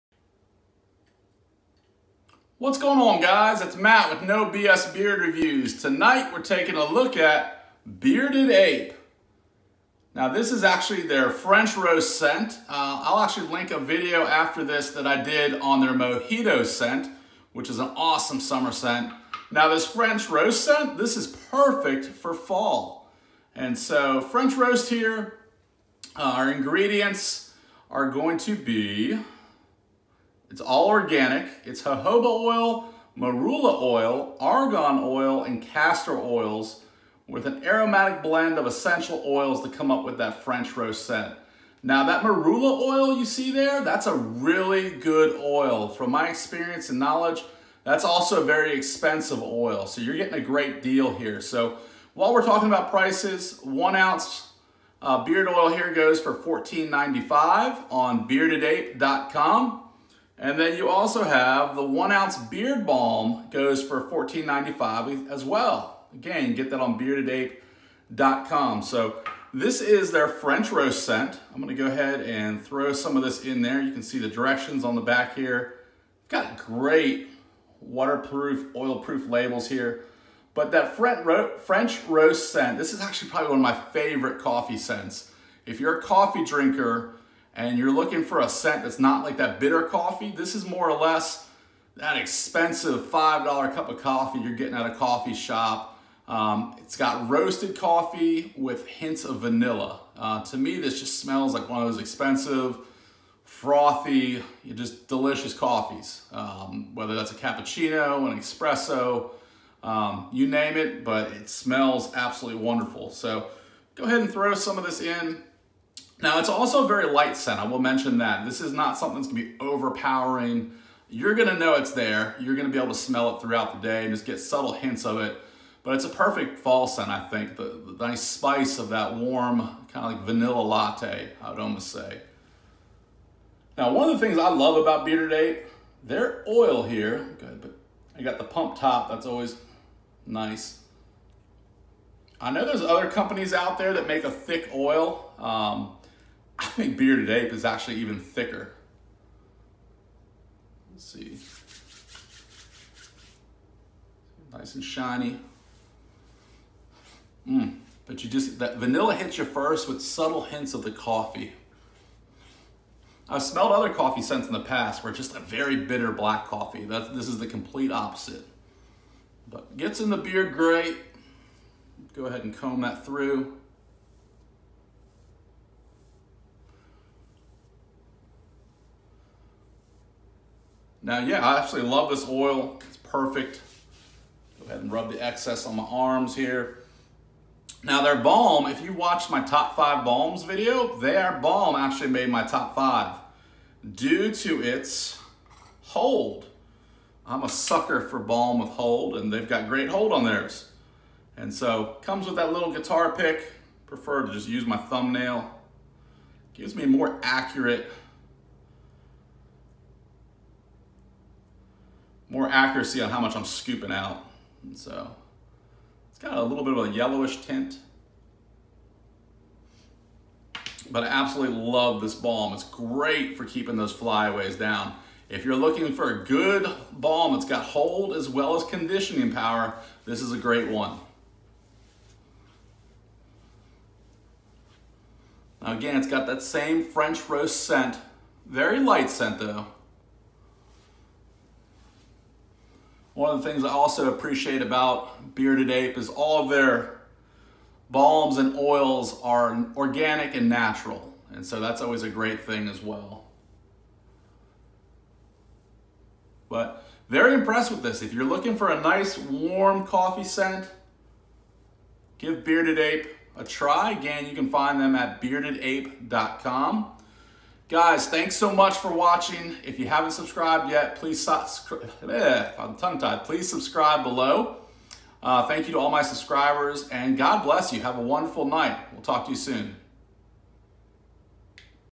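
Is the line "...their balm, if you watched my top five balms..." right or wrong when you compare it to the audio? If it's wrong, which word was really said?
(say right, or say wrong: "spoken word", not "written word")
right.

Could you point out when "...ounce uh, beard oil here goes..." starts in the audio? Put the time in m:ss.
0:53.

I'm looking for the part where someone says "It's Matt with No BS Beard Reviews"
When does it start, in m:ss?
0:03.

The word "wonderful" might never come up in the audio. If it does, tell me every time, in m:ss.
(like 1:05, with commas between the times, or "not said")
1:52, 4:38.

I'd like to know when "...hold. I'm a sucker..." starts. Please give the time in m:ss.
3:15.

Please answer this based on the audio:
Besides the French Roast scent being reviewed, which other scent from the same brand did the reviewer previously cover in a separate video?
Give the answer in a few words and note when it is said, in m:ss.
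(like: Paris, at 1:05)
Mojito, at 0:15.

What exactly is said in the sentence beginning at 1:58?
This is not something that's gonna be overpowering.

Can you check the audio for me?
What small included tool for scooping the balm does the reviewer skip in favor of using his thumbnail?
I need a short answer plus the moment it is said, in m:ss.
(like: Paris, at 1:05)
Guitar pick, at 3:22.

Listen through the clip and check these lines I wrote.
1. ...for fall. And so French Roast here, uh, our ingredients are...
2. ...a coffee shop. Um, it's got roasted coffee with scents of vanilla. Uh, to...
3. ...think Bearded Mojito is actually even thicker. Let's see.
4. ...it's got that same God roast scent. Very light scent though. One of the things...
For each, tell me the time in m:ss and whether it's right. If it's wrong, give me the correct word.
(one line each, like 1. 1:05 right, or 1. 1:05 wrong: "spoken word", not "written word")
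1. 0:22 right
2. 1:34 wrong: "hints", not "scents"
3. 2:26 wrong: "Ape", not "Mojito"
4. 3:55 wrong: "French", not "God".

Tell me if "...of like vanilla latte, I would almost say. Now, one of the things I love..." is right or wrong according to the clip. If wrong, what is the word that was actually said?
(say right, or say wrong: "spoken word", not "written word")
right.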